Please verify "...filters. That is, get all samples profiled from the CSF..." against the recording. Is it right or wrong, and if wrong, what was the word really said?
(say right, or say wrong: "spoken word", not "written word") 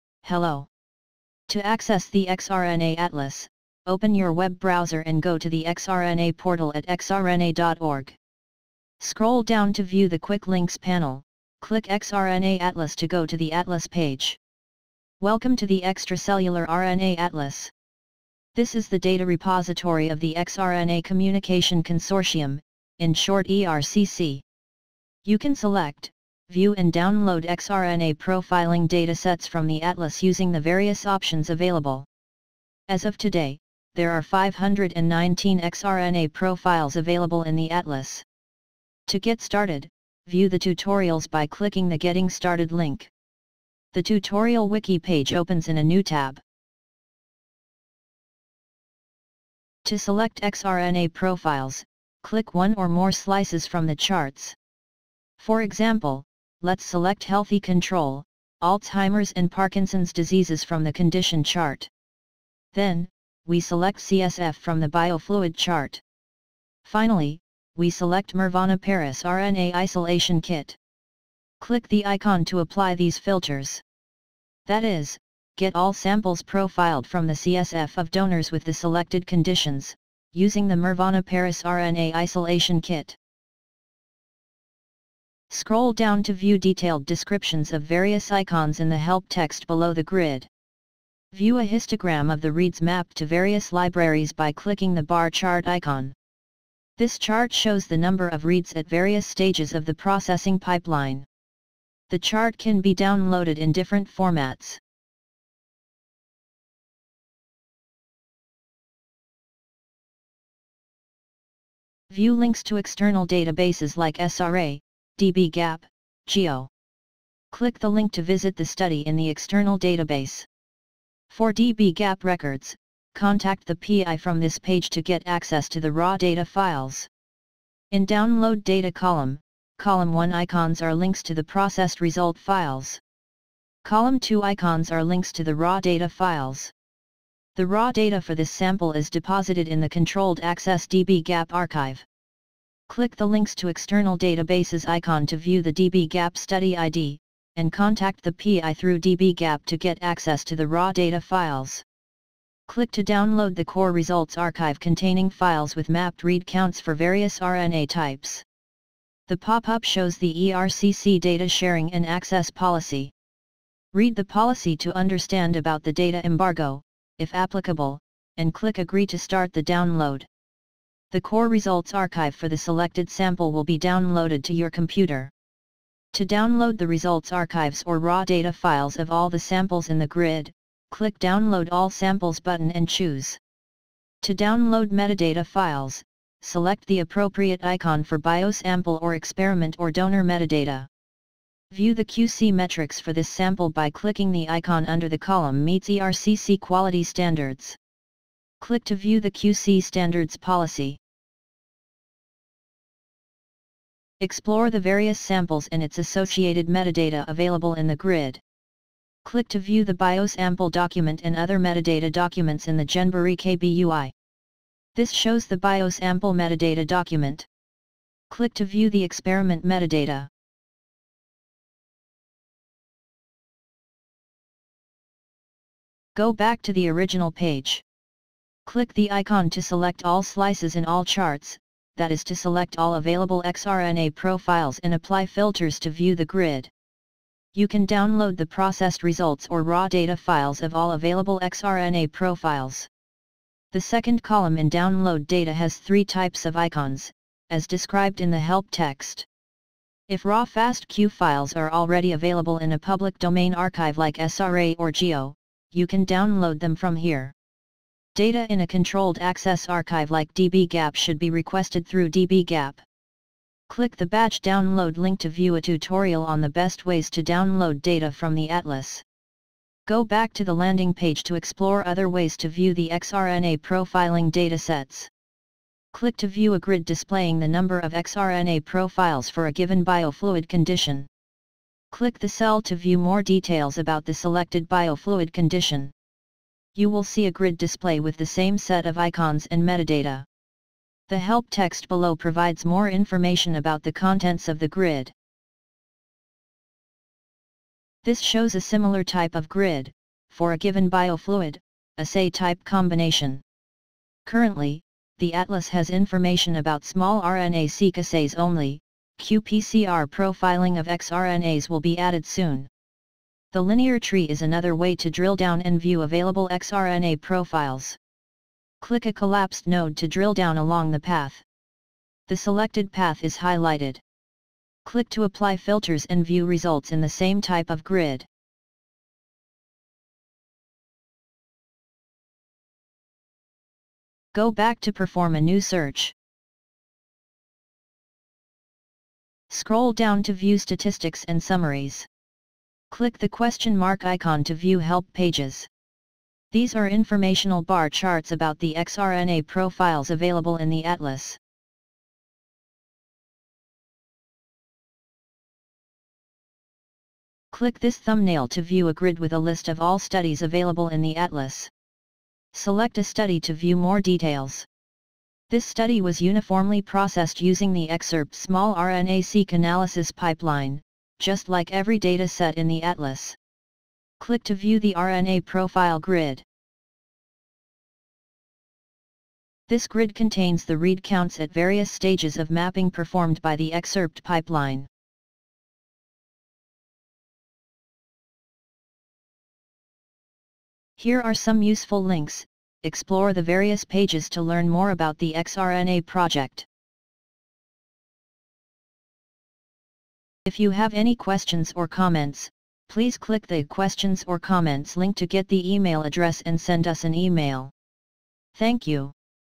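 right.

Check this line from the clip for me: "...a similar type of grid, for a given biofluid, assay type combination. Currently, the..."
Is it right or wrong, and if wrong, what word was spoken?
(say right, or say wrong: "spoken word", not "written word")
right.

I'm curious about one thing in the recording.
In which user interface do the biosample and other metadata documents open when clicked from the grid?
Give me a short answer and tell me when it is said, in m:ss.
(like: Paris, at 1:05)
GenboreeKB UI, at 3:32.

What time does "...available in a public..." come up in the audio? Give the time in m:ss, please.
4:12.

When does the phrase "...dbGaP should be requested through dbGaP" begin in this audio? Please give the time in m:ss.
4:20.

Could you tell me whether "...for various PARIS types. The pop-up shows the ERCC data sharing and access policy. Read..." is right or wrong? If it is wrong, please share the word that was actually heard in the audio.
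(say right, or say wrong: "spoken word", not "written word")
wrong: "RNA", not "PARIS".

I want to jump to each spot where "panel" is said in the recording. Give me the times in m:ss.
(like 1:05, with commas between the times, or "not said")
0:10.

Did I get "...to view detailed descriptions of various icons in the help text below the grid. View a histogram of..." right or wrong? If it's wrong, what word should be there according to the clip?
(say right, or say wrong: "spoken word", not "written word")
right.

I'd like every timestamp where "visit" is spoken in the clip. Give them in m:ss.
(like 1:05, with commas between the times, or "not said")
1:58.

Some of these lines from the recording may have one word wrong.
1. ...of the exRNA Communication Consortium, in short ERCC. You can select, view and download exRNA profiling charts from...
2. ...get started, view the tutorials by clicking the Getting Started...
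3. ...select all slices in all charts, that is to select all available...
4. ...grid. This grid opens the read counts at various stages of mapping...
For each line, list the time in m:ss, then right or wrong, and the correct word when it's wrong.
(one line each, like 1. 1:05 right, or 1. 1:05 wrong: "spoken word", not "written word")
1. 0:20 wrong: "datasets", not "charts"
2. 0:39 right
3. 3:49 right
4. 6:15 wrong: "contains", not "opens".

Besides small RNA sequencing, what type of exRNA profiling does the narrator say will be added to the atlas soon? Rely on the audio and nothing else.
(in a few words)
qPCR.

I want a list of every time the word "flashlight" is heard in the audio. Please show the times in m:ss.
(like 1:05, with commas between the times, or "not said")
not said.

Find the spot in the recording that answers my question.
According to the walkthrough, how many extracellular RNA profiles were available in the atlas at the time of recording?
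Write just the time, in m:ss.
0:34.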